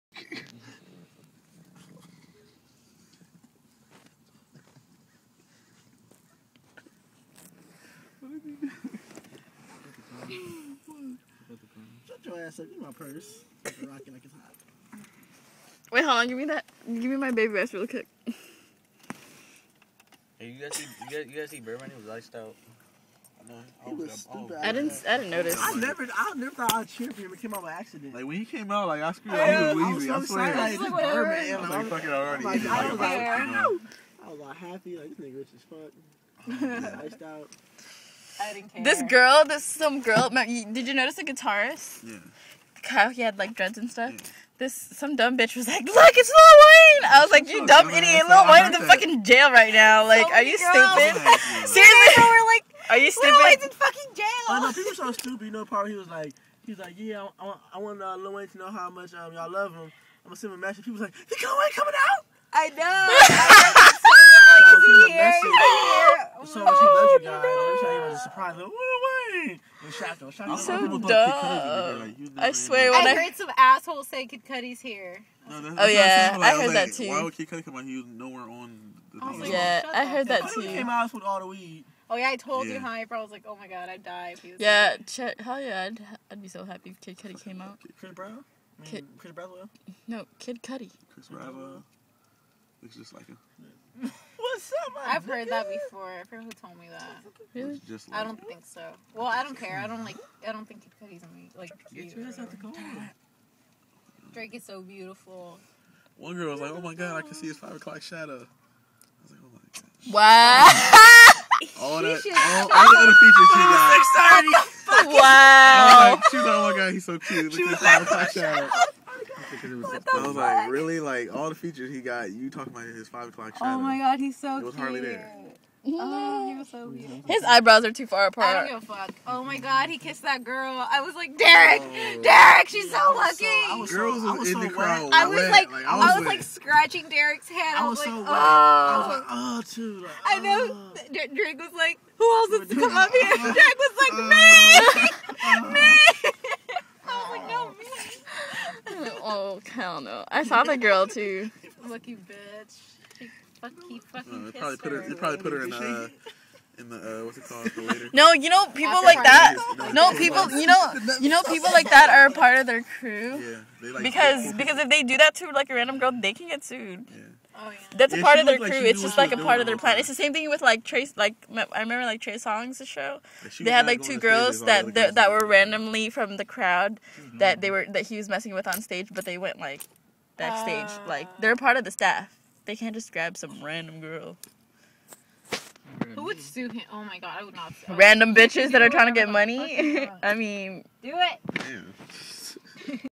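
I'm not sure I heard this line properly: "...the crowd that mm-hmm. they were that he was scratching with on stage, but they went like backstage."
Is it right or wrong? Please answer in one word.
wrong.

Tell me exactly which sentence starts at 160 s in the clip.
You know, you know people like that are a part of their crew.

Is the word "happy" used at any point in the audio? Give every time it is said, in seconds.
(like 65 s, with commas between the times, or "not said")
34 s, 86 s.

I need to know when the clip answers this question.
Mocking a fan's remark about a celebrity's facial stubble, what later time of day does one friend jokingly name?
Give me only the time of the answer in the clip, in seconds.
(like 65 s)
114 s.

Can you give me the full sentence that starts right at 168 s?
Like it's just like a part of their plan.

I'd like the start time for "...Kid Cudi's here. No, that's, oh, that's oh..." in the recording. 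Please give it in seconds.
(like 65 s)
74 s.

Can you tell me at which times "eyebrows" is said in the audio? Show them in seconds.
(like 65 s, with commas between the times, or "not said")
127 s.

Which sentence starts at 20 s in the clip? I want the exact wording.
Hey, you guys see, you guys, you guys see Birdman?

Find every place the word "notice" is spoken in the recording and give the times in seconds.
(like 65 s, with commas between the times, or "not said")
25 s, 40 s.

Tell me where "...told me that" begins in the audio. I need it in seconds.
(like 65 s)
96 s.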